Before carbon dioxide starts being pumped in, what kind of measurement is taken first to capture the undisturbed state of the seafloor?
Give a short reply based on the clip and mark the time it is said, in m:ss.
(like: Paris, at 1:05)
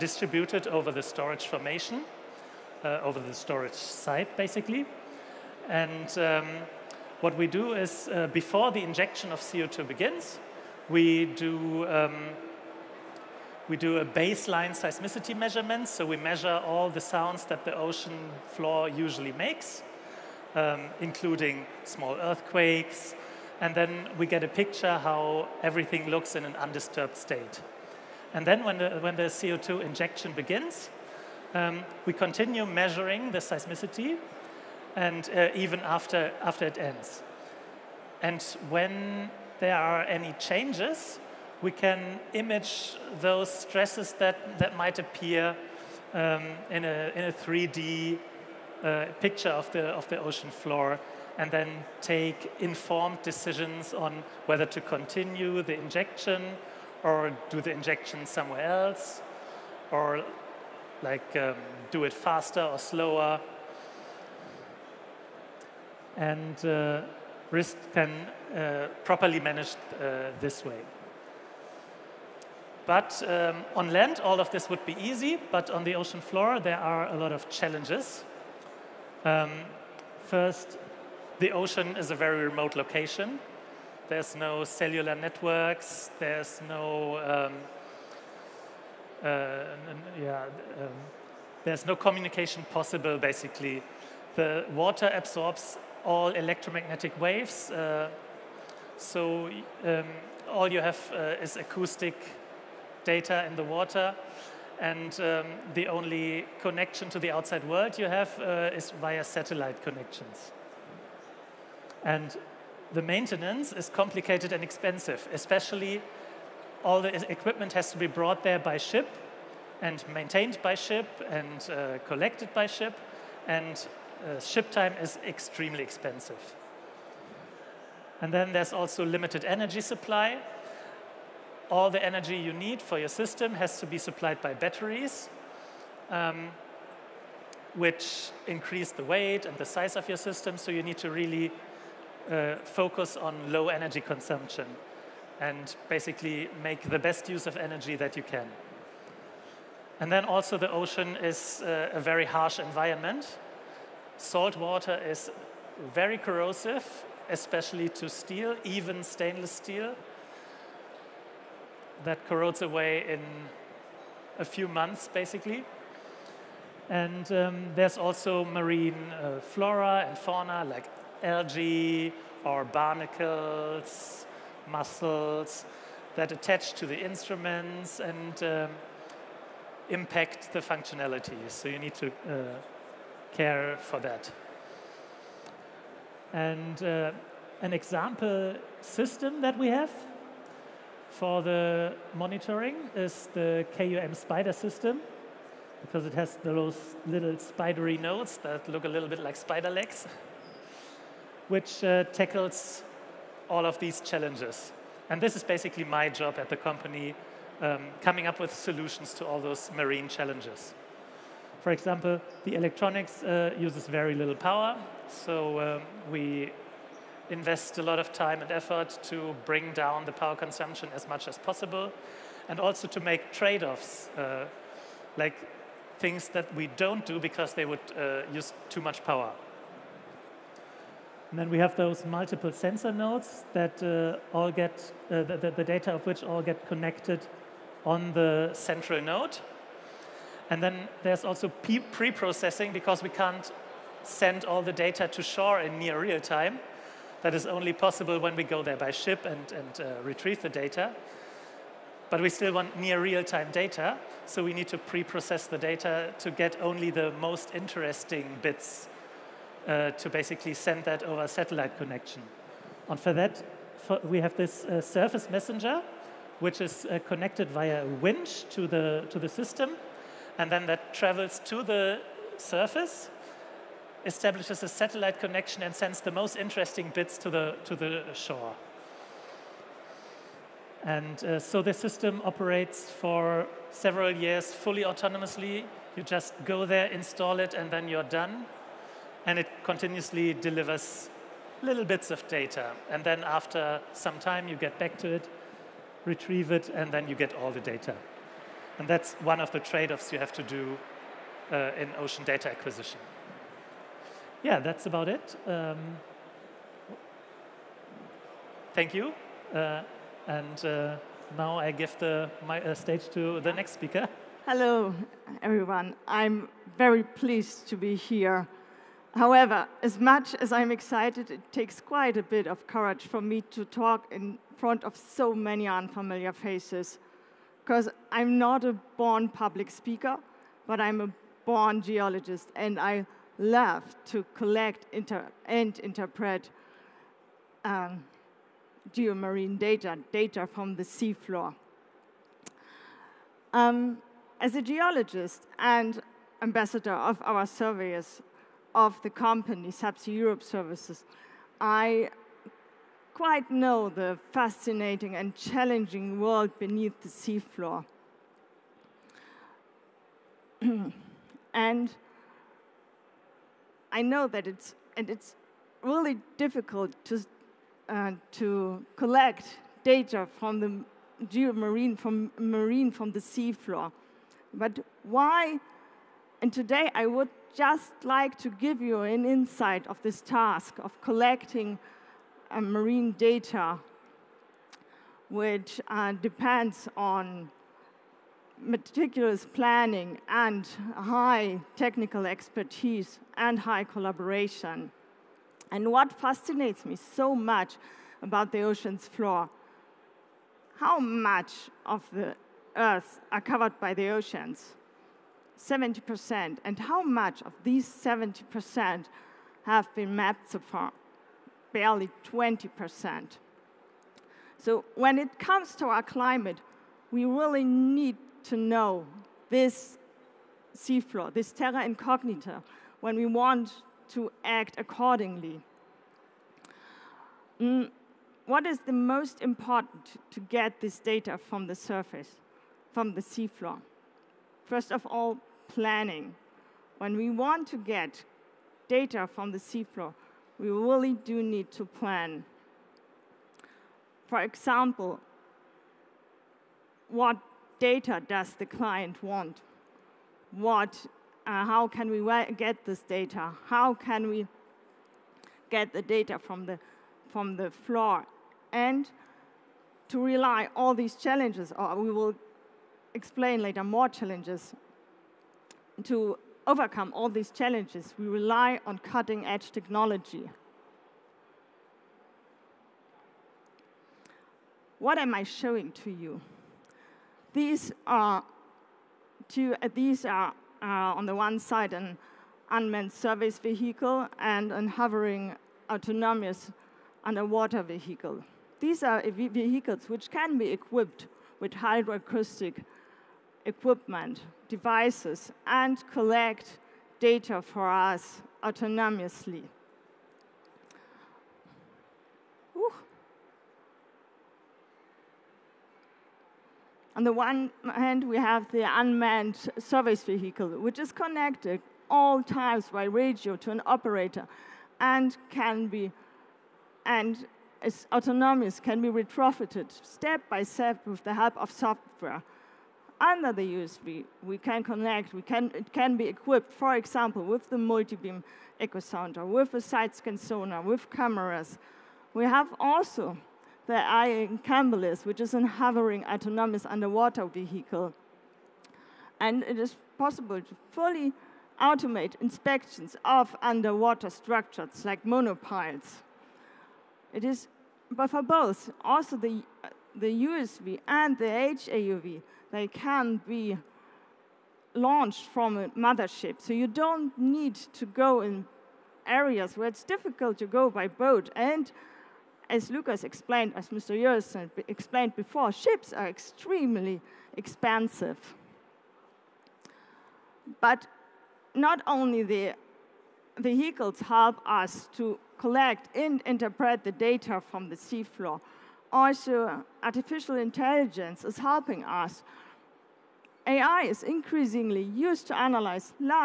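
Baseline seismicity measurement, at 0:14.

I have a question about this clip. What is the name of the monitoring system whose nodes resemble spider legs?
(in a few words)
KUM spider system.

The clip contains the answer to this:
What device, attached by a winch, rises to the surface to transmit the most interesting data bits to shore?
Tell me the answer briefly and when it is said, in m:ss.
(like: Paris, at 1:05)
Surface messenger, at 4:24.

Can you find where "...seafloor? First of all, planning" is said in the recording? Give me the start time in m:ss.
7:13.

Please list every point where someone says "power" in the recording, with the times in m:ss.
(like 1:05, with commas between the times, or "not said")
3:34, 3:40, 3:49.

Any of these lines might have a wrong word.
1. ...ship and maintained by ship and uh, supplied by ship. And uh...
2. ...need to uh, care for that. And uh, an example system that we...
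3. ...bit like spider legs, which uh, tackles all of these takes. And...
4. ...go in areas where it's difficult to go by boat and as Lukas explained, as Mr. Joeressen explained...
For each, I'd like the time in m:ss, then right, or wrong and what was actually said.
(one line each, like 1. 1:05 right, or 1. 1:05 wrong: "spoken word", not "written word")
1. 1:58 wrong: "collected", not "supplied"
2. 3:01 right
3. 3:19 wrong: "challenges", not "takes"
4. 9:18 right.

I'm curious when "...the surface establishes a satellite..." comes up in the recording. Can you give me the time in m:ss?
4:31.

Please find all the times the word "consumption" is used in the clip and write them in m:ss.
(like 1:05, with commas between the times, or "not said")
2:24, 3:40.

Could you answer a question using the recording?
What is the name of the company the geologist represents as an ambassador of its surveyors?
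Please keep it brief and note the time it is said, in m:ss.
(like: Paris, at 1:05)
Subsea Europe Services, at 5:49.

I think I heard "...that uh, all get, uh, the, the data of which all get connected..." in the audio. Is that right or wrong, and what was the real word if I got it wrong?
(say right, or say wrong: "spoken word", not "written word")
right.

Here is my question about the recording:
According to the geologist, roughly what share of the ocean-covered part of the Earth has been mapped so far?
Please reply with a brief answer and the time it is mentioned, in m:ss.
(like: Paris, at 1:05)
20%, at 6:52.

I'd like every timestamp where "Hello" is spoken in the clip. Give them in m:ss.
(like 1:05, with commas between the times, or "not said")
5:14.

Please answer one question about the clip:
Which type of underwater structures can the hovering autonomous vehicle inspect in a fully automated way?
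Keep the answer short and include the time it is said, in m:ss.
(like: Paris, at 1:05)
Monopiles, at 9:05.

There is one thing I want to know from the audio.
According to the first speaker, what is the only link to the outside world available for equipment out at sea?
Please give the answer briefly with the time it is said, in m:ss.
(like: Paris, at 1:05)
Satellite connections, at 1:49.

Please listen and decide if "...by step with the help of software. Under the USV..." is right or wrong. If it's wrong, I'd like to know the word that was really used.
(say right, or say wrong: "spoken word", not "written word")
right.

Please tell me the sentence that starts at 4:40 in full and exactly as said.
And uh, so the system operates for several years fully autonomously.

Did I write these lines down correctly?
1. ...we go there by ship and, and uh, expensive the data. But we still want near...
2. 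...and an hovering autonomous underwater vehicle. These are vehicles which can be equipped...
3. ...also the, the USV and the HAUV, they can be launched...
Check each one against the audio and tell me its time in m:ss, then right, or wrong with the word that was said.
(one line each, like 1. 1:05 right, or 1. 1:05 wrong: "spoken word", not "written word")
1. 4:08 wrong: "retrieve", not "expensive"
2. 8:04 right
3. 9:09 right.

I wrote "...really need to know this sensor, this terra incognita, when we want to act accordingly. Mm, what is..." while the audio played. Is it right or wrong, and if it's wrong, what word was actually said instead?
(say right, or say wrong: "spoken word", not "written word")
wrong: "seafloor", not "sensor".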